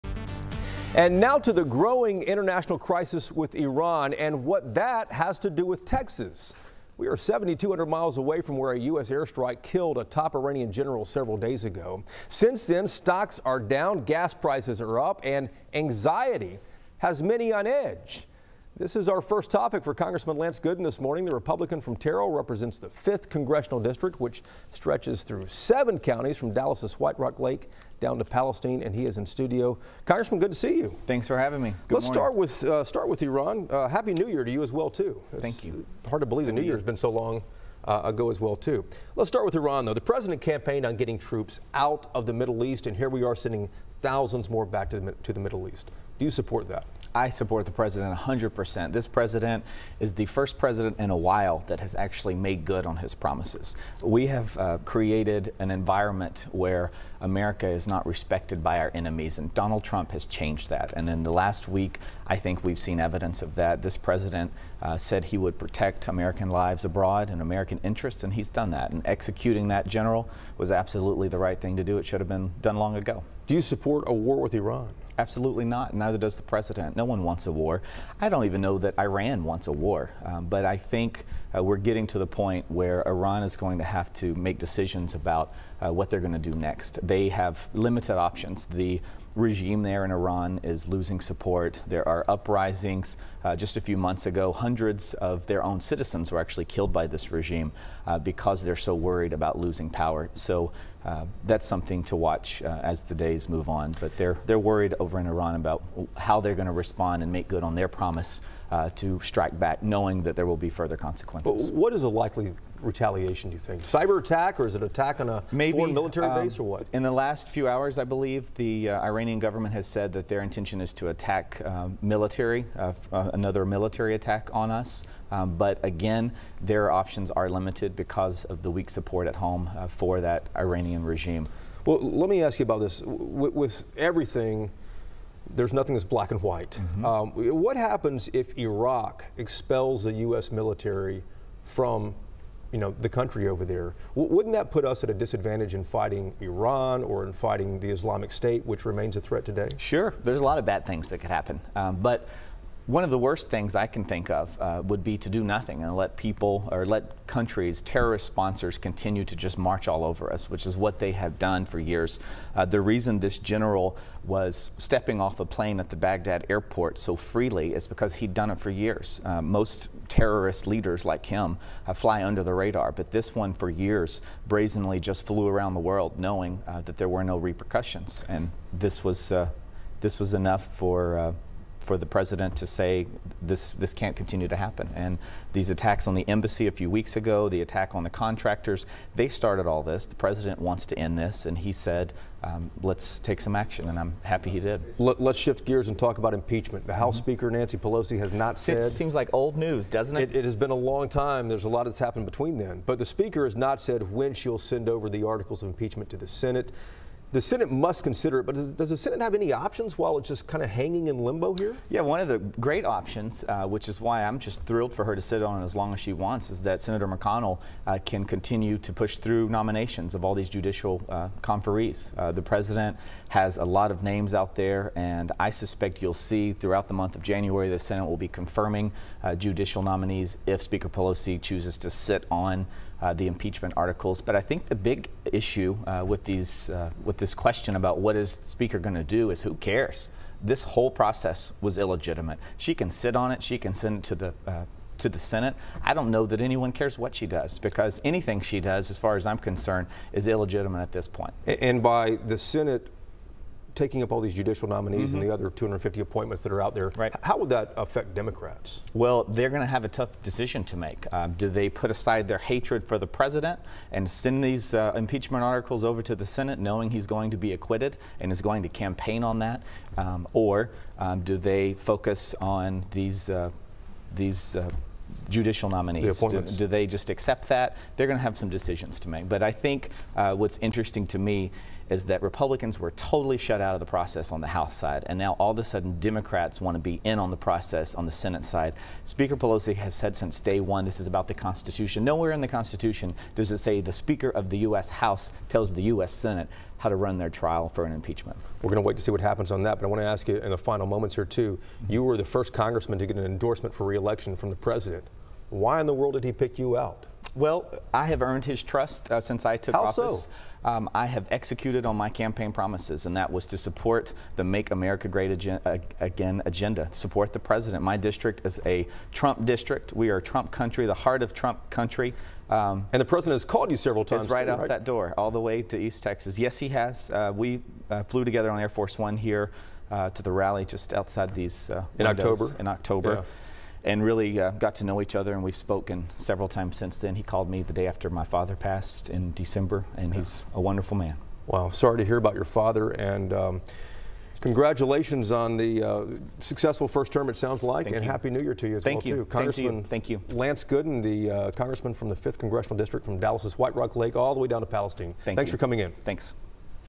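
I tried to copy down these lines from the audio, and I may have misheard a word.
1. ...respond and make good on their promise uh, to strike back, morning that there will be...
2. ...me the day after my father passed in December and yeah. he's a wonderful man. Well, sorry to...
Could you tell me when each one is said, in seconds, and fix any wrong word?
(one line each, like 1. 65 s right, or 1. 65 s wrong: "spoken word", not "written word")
1. 106 s wrong: "knowing", not "morning"
2. 337 s right.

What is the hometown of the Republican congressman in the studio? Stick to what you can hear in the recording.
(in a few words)
Terrell.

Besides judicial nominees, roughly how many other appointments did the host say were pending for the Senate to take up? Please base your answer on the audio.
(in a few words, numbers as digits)
250.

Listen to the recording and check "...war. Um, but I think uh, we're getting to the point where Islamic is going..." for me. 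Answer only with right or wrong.
wrong.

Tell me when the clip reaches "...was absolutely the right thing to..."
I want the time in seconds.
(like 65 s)
70 s.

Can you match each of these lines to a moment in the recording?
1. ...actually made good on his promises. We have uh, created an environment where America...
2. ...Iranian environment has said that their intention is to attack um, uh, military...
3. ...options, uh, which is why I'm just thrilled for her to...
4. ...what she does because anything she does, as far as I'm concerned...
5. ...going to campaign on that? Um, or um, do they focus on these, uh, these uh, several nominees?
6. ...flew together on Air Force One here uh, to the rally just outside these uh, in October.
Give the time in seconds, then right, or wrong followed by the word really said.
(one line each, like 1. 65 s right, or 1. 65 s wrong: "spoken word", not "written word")
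1. 51 s right
2. 119 s wrong: "government", not "environment"
3. 212 s right
4. 246 s right
5. 268 s wrong: "judicial", not "several"
6. 328 s right.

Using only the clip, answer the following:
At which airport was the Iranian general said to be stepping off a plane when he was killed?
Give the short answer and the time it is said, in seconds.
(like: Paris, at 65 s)
Baghdad airport, at 165 s.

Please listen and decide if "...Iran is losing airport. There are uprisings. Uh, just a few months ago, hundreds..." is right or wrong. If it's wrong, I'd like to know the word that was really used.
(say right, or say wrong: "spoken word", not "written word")
wrong: "support", not "airport".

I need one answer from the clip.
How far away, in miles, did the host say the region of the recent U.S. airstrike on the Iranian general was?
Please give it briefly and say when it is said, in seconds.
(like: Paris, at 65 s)
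7,200 miles, at 7 s.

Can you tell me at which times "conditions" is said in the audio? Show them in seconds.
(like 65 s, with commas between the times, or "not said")
not said.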